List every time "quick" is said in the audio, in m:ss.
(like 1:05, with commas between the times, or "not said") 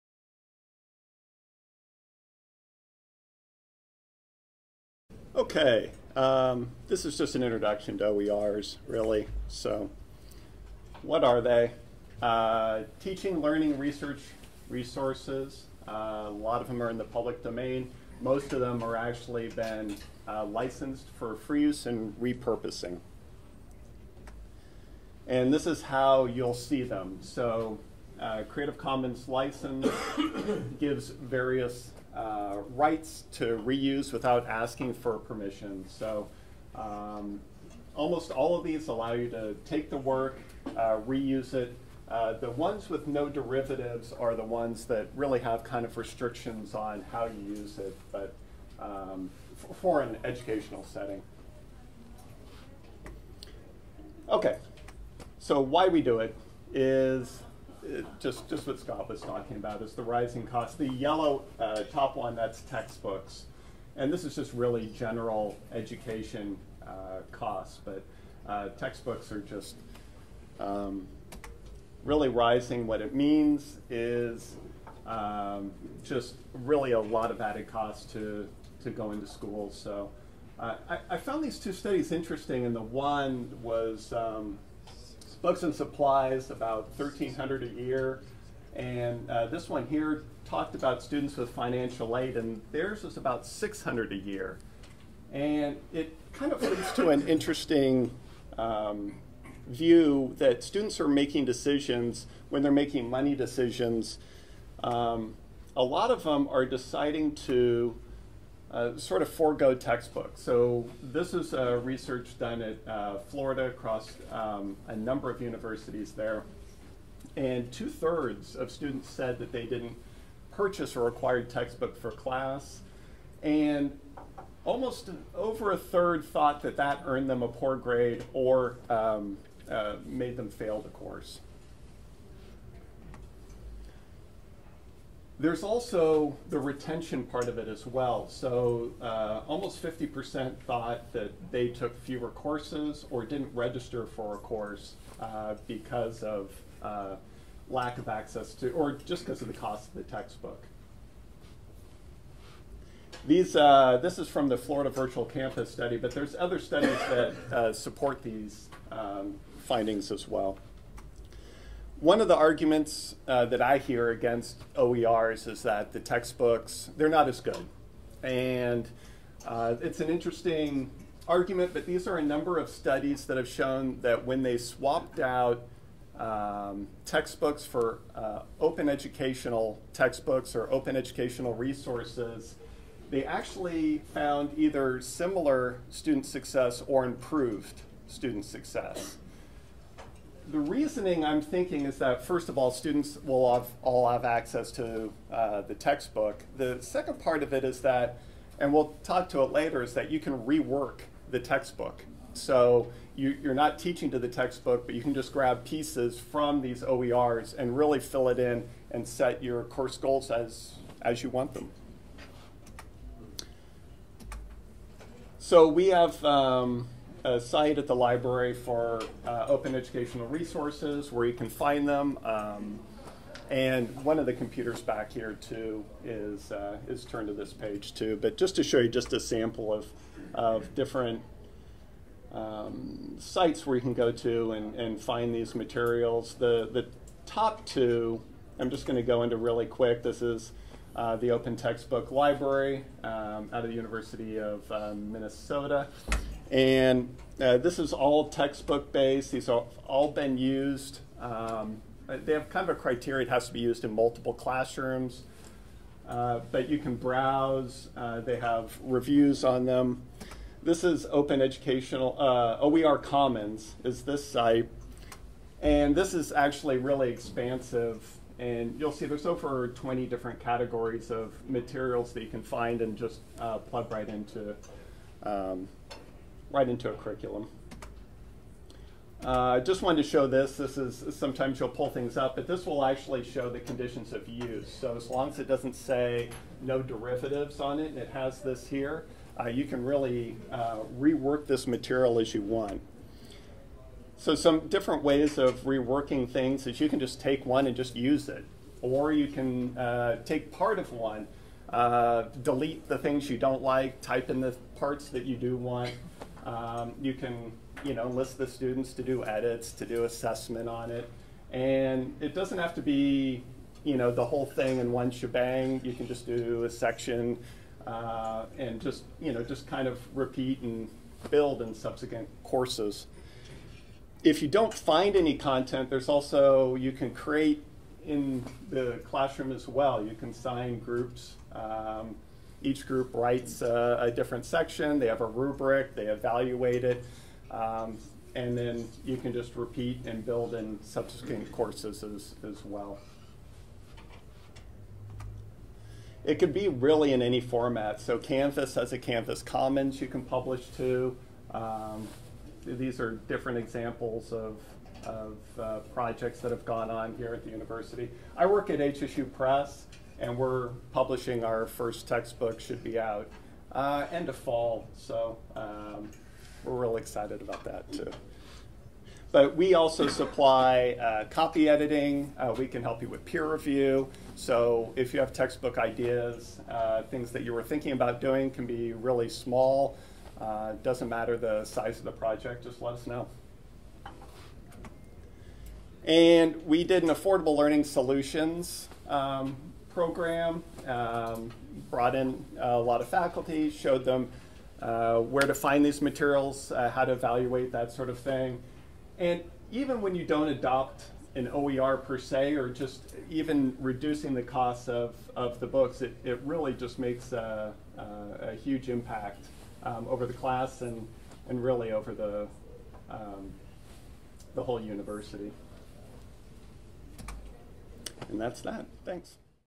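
3:59.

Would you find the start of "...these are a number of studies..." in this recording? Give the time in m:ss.
2:51.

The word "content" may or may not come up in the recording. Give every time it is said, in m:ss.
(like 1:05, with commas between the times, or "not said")
5:25.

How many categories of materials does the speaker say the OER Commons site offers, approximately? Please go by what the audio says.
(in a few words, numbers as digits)
Over 20.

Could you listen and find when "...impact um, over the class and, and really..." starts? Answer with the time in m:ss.
6:48.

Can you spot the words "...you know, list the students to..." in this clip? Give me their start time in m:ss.
5:07.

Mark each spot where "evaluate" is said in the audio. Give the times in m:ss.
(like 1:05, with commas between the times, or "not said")
5:36, 6:37.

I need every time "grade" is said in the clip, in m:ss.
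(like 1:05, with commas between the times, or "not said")
2:07.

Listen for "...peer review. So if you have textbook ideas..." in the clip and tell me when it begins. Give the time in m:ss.
6:13.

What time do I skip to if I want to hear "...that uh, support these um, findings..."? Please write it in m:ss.
2:37.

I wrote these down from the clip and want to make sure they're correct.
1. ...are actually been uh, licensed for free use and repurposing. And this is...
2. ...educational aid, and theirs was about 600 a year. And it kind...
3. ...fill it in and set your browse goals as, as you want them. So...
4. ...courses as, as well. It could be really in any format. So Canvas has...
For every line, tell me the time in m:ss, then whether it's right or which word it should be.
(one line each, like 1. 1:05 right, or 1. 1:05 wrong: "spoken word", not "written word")
1. 0:18 right
2. 1:31 wrong: "financial", not "educational"
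3. 3:27 wrong: "course", not "browse"
4. 5:41 right.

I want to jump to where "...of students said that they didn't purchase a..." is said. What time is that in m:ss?
1:58.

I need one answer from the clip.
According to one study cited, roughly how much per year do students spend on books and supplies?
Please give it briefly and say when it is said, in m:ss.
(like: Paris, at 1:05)
1,300, at 1:26.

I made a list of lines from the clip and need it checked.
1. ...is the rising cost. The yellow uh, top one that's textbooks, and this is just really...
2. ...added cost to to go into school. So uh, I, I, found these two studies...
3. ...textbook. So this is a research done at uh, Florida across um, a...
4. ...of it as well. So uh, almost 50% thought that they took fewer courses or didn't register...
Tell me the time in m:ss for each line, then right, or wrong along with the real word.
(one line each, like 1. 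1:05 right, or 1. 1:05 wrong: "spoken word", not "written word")
1. 0:59 right
2. 1:17 right
3. 1:49 right
4. 2:17 right.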